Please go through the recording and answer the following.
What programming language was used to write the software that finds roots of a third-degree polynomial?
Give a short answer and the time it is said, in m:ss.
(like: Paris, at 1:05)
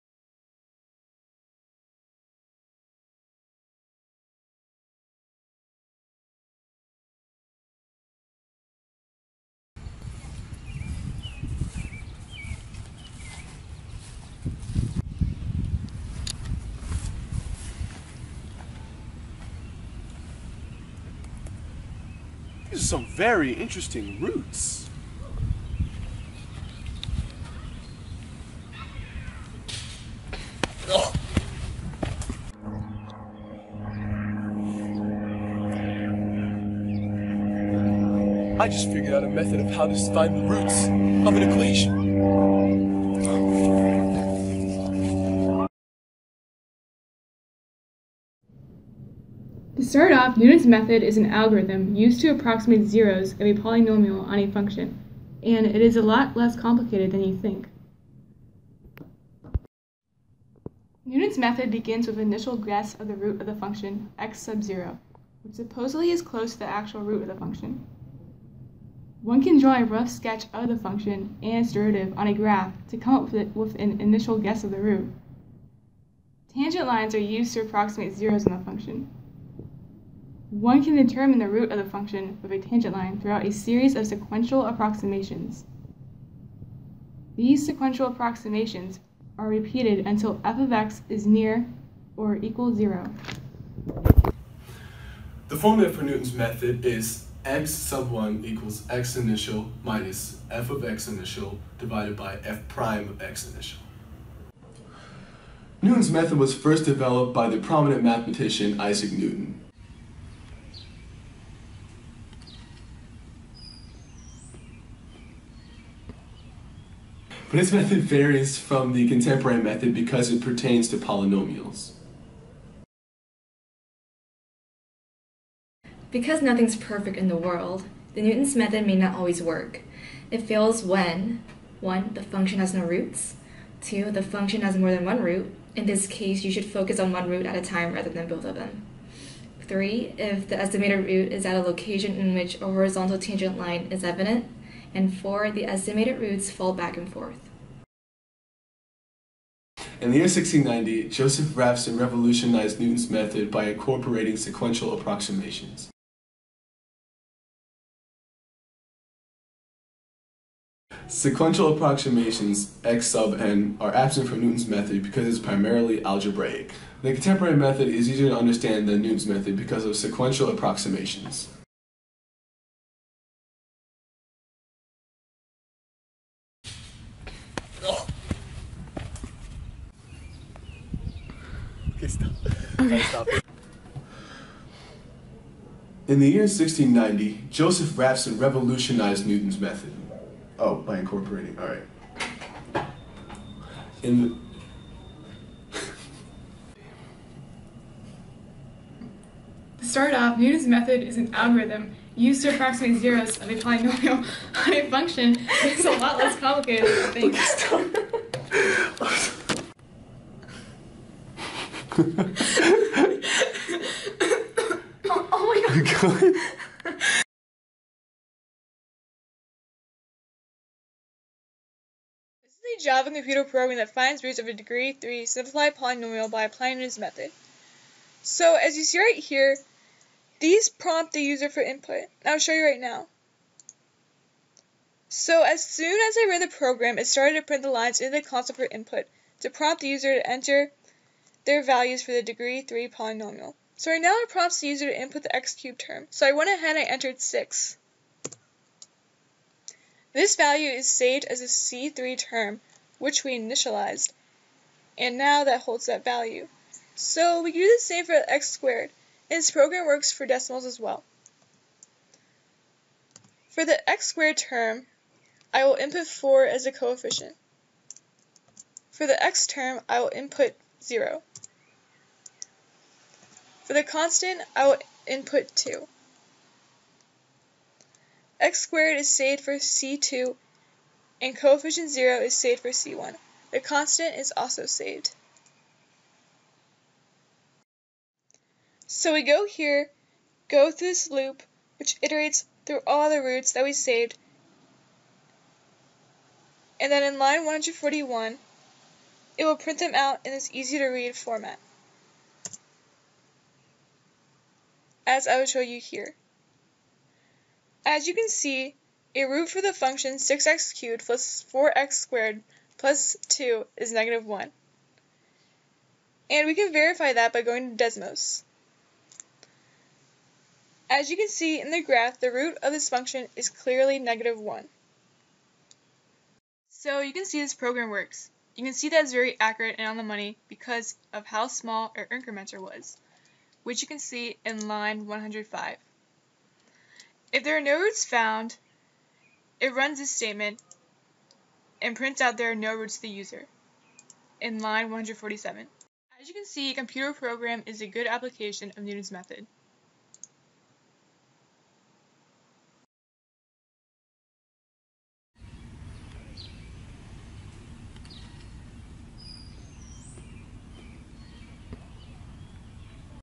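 Java, at 3:42.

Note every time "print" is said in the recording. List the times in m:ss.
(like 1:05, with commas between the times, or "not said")
3:57, 4:59, 5:41.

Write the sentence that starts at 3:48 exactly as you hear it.
So as you see right here, these prompt the user for input.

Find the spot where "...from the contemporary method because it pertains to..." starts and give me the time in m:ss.
1:58.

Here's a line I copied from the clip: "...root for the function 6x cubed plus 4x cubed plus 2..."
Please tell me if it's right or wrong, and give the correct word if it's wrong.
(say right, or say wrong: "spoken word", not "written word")
wrong: "squared", not "cubed".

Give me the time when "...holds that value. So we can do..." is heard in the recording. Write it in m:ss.
4:15.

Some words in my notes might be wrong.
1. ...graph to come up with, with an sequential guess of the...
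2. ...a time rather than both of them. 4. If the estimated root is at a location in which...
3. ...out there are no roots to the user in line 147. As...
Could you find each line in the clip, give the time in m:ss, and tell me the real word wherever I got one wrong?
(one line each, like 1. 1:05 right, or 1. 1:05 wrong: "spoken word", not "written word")
1. 1:12 wrong: "initial", not "sequential"
2. 2:17 wrong: "3", not "4"
3. 5:42 right.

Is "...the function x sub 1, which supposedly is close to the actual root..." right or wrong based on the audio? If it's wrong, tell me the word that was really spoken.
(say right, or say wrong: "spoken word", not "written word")
wrong: "0", not "1".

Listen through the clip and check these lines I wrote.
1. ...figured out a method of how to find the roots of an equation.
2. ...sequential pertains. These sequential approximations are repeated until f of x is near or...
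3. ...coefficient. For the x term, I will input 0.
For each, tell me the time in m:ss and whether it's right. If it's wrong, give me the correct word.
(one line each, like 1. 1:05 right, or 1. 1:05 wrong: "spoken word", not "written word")
1. 0:38 right
2. 1:24 wrong: "approximations", not "pertains"
3. 4:26 right.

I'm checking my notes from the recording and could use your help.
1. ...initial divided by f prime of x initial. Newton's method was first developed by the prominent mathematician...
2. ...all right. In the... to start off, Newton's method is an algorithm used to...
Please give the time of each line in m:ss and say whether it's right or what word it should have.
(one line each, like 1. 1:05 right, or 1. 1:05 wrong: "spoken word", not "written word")
1. 1:41 right
2. 3:11 right.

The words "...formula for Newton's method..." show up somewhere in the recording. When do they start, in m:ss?
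1:35.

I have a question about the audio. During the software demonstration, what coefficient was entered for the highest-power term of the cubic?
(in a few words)
6.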